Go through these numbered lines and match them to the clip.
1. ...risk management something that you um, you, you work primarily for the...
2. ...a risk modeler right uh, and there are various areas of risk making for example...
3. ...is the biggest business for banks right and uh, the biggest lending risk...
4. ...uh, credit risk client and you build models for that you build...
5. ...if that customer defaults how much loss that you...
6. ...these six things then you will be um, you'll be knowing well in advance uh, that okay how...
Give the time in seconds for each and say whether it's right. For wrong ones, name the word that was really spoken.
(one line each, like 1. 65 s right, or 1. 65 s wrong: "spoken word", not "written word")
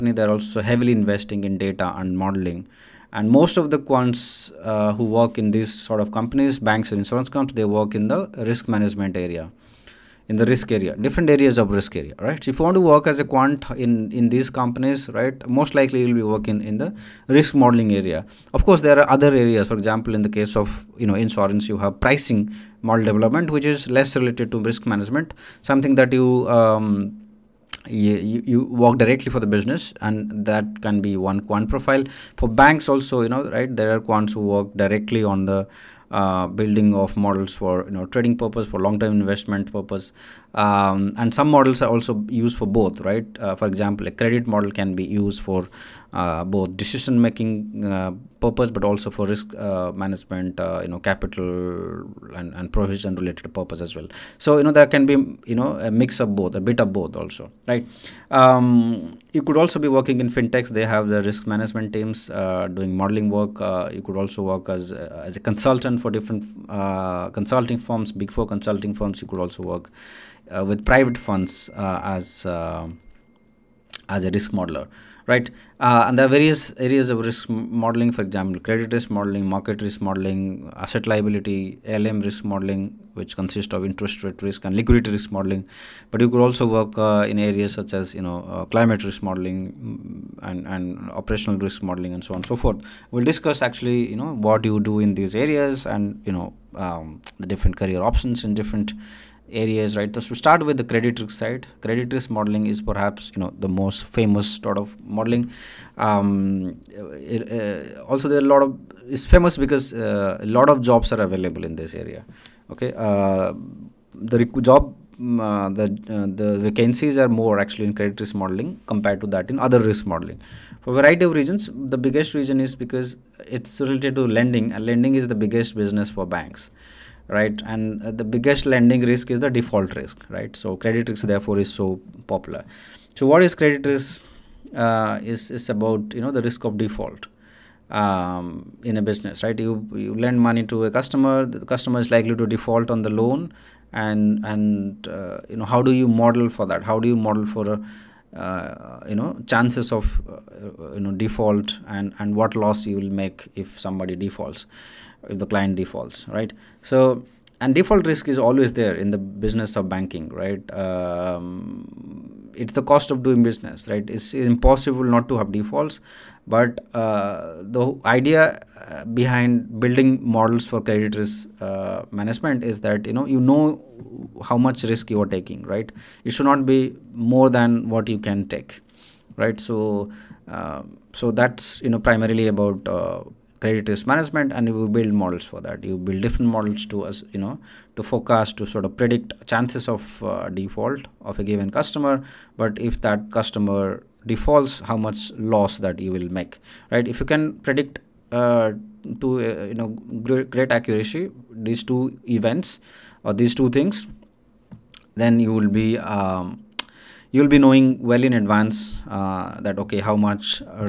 1. 24 s wrong: "directly", not "primarily"
2. 74 s wrong: "modeling", not "making"
3. 125 s right
4. 182 s wrong: "management", not "client"
5. 192 s right
6. 203 s wrong: "two", not "six".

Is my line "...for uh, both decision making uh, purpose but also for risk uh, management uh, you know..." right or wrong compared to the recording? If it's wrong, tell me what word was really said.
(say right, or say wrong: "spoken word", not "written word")
right.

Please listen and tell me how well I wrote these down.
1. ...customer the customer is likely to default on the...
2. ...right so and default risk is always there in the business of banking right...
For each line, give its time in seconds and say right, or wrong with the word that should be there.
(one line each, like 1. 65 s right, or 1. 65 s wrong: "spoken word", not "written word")
1. 140 s right
2. 156 s right.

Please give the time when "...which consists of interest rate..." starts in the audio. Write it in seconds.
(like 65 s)
83 s.